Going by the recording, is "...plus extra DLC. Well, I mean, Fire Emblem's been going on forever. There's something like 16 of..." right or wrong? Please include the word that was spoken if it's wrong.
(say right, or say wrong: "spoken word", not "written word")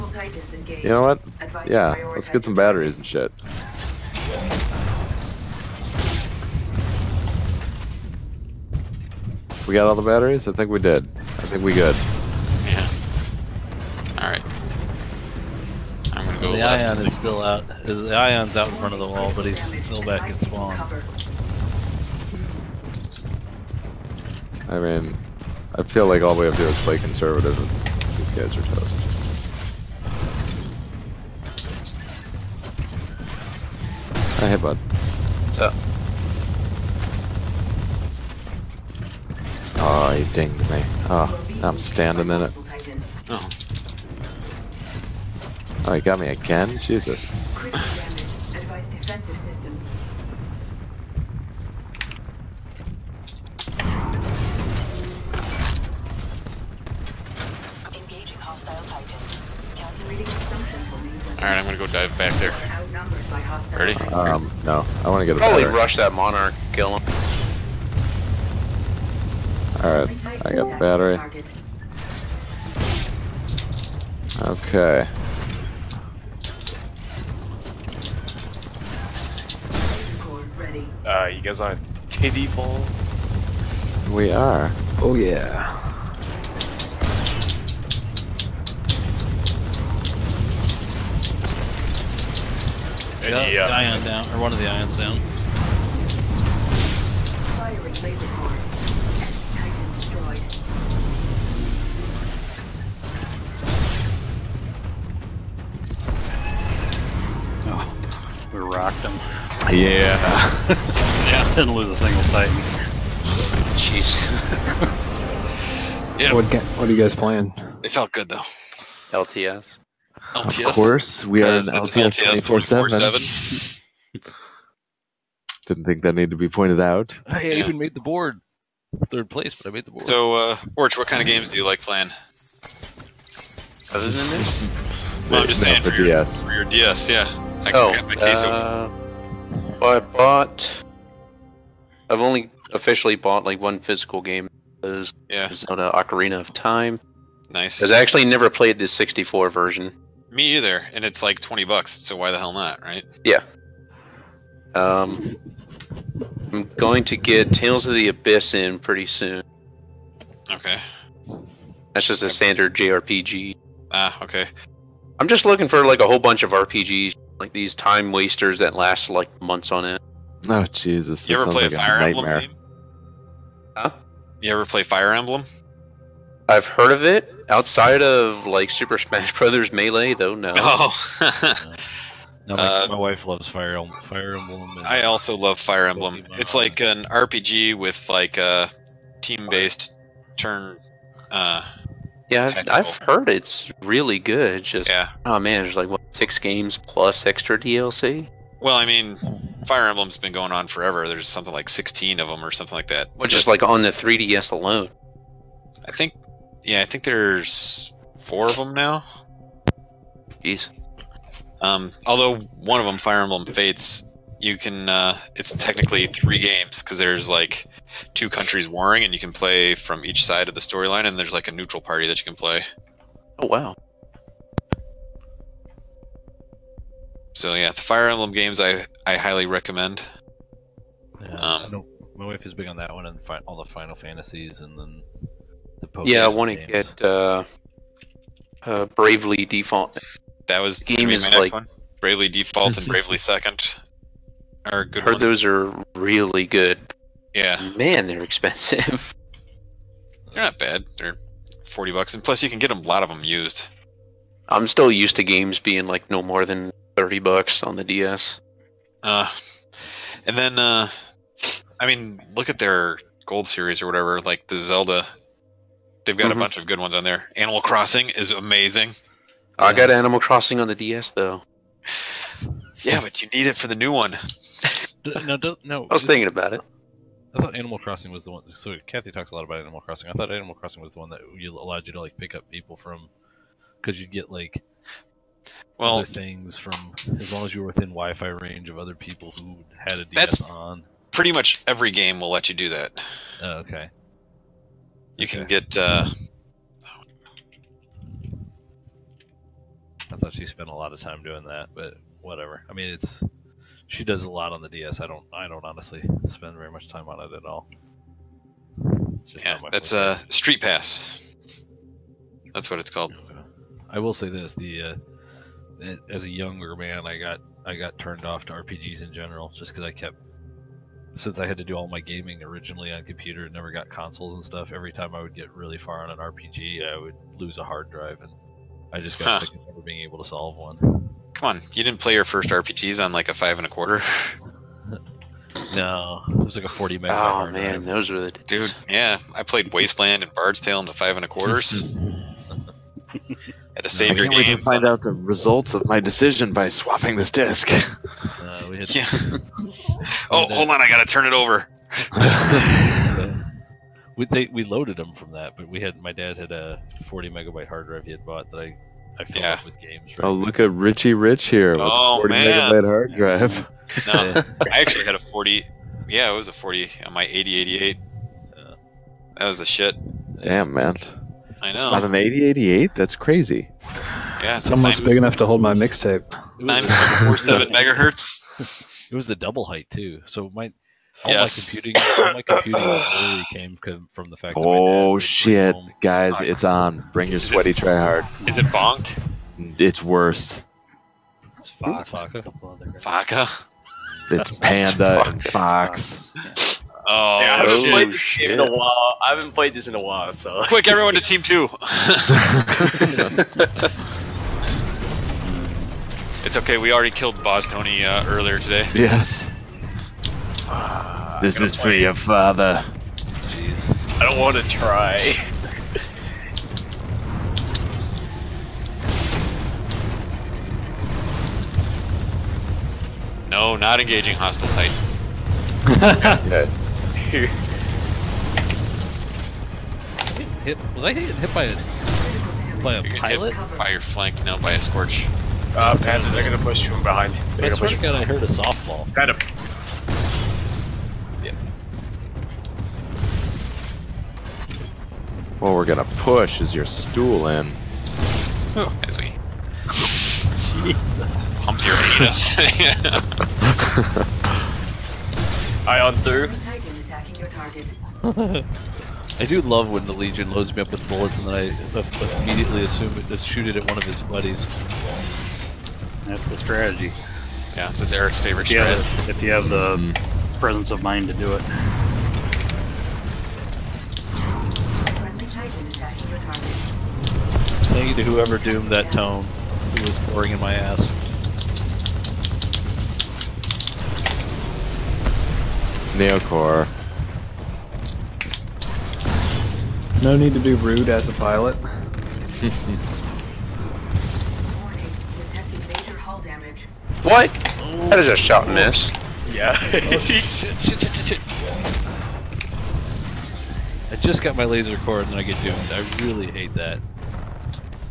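right.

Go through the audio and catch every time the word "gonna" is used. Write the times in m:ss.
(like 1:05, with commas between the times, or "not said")
0:16, 7:16, 7:25.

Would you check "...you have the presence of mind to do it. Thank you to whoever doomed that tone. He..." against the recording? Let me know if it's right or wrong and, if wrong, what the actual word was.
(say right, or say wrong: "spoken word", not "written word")
right.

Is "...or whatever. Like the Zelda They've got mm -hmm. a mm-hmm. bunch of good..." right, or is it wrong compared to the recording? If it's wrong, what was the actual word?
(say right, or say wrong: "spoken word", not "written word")
right.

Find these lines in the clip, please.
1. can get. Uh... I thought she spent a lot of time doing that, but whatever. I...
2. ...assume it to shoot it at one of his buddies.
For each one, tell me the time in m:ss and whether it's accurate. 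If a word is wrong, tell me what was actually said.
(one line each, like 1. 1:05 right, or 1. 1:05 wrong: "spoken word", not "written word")
1. 4:55 right
2. 7:42 right.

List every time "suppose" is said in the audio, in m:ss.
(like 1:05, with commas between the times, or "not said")
not said.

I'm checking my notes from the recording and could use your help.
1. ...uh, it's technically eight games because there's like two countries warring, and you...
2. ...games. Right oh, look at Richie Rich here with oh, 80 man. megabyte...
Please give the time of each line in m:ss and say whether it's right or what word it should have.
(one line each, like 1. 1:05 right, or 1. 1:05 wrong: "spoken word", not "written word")
1. 3:34 wrong: "three", not "eight"
2. 5:59 wrong: "40", not "80".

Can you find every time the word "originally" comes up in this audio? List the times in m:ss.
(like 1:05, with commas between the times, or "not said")
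5:22.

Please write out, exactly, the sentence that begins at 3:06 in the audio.
It's like an RPG with like a uh, team-based turn.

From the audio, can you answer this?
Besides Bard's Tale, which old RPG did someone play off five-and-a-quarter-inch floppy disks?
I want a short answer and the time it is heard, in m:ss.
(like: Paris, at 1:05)
Wasteland, at 5:39.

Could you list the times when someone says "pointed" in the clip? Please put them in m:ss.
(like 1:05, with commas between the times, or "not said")
2:06.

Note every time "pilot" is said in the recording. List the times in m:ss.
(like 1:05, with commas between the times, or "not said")
7:13, 8:11.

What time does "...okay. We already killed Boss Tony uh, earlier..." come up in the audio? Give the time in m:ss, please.
6:46.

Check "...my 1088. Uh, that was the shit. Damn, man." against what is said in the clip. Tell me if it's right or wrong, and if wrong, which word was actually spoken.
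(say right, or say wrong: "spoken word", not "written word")
wrong: "8088", not "1088".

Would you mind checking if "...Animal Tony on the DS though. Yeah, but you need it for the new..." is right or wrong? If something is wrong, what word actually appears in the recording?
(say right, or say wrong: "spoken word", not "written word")
wrong: "Crossing", not "Tony".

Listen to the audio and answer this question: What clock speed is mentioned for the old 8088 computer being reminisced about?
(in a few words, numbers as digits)
9.47 megahertz.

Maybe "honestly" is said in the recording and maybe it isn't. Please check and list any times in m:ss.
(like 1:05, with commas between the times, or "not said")
5:05.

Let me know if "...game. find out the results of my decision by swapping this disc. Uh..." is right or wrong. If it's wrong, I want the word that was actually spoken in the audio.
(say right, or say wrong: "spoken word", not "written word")
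right.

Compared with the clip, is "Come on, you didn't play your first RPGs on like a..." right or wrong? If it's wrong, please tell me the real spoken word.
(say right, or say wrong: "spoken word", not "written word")
right.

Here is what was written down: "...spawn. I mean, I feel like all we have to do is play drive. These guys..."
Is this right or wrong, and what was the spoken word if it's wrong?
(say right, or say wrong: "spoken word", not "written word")
wrong: "conservative", not "drive".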